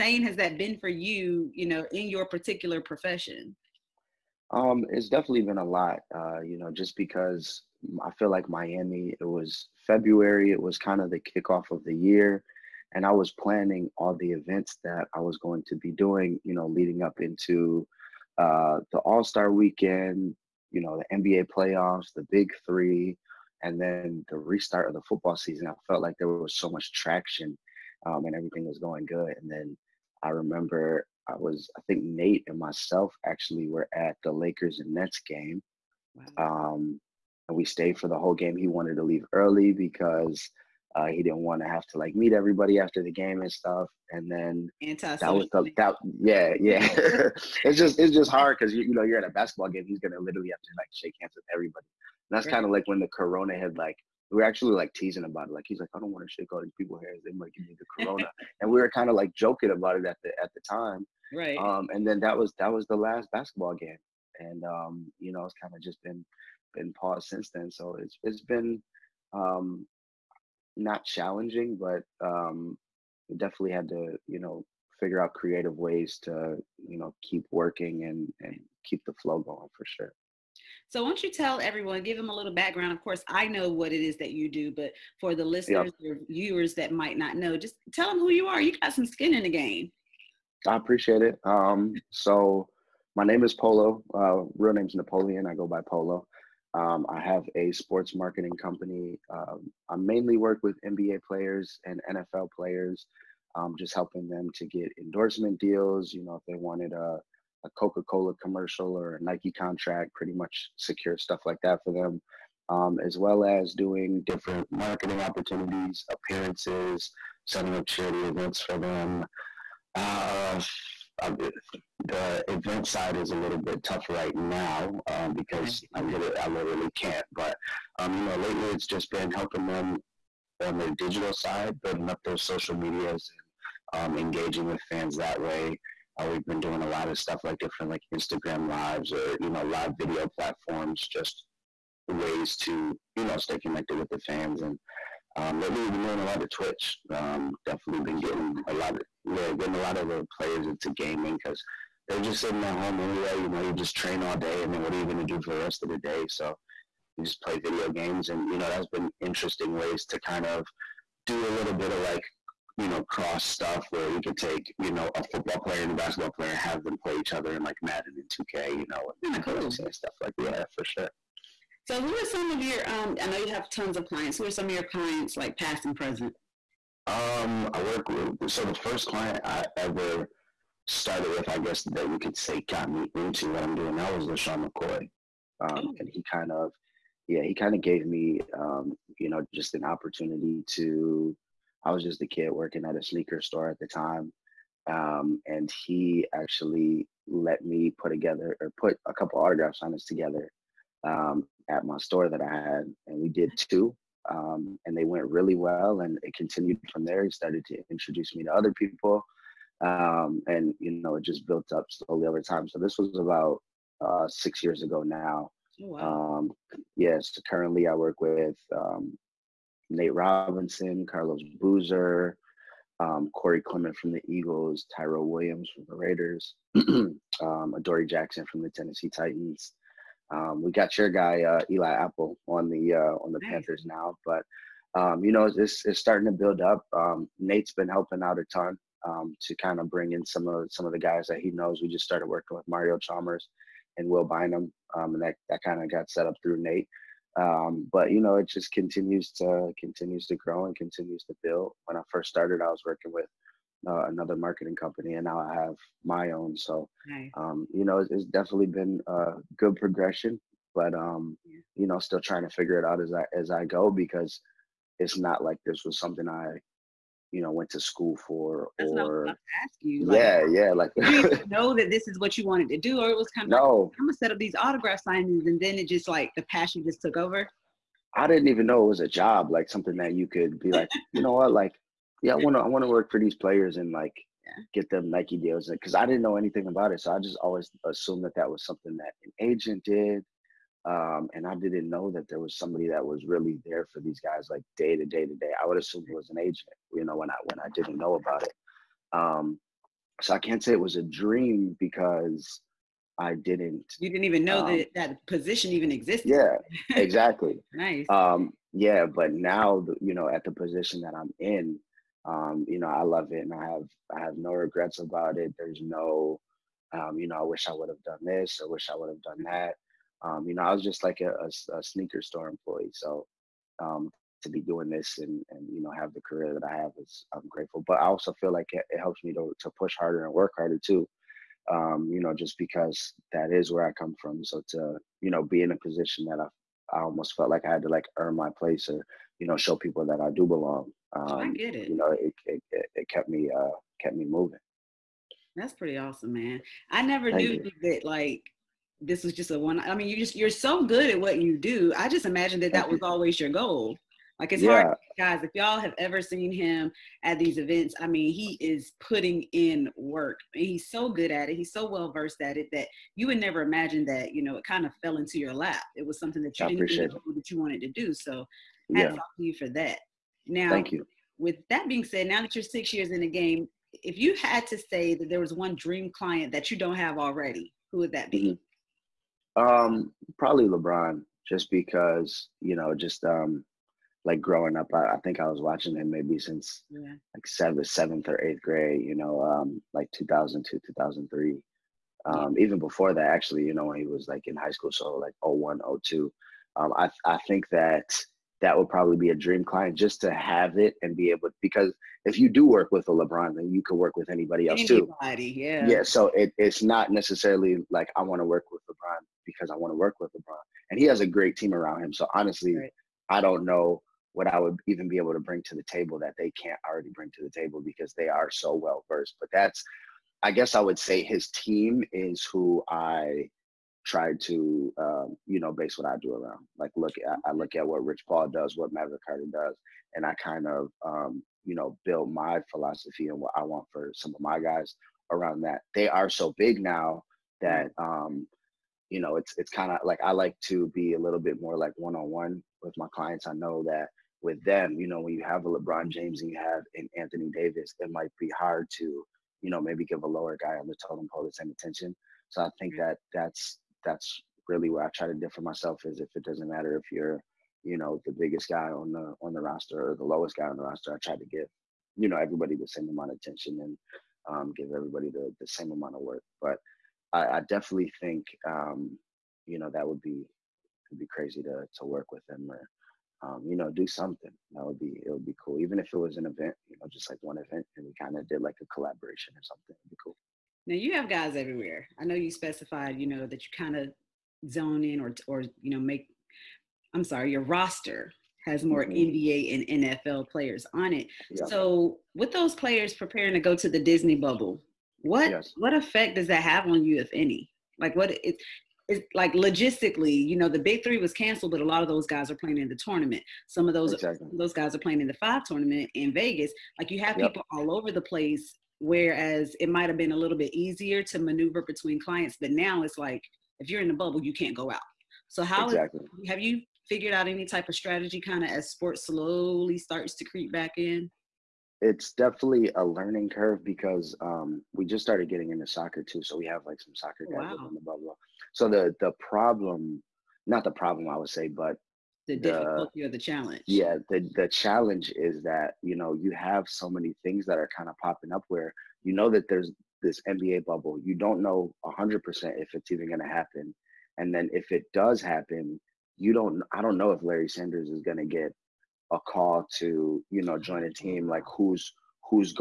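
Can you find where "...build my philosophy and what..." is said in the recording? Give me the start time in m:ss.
7:12.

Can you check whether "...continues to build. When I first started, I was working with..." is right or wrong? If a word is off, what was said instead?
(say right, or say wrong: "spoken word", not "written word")
right.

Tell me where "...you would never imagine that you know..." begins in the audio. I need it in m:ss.
6:03.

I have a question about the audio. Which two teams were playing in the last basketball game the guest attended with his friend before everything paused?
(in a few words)
Lakers and Nets.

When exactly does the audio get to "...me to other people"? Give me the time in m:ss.
3:28.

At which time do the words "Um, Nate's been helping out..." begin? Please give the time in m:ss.
3:56.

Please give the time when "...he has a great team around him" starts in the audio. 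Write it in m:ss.
6:50.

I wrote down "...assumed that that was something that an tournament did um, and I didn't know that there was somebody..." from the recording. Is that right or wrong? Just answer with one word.
wrong.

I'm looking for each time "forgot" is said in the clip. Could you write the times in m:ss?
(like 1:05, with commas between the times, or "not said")
not said.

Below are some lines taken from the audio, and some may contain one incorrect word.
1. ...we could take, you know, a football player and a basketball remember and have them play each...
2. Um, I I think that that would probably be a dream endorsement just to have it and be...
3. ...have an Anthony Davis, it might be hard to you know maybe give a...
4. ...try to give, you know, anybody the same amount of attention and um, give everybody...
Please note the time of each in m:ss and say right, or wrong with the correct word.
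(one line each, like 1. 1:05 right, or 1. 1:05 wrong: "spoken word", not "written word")
1. 2:44 wrong: "player", not "remember"
2. 6:36 wrong: "client", not "endorsement"
3. 7:26 right
4. 7:41 wrong: "everybody", not "anybody".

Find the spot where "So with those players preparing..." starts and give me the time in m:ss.
8:11.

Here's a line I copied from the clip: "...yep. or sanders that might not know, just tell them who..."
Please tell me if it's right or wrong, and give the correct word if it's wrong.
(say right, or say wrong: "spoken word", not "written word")
wrong: "viewers", not "sanders".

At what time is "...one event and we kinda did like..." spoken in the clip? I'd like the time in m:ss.
7:57.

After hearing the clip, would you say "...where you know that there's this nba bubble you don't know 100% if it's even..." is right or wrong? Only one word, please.
right.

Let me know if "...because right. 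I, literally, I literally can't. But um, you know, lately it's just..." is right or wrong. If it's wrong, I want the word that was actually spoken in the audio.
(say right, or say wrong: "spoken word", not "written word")
right.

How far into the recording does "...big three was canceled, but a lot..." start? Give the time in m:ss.
8:20.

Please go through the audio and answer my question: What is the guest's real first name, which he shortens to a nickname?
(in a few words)
Napoleon.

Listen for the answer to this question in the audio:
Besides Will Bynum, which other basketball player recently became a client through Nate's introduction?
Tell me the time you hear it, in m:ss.
4:02.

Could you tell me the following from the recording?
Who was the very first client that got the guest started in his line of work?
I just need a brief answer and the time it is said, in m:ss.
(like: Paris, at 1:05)
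LeSean McCoy, at 3:04.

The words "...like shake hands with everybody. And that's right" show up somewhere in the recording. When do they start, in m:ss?
0:50.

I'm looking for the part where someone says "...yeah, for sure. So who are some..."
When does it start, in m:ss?
2:50.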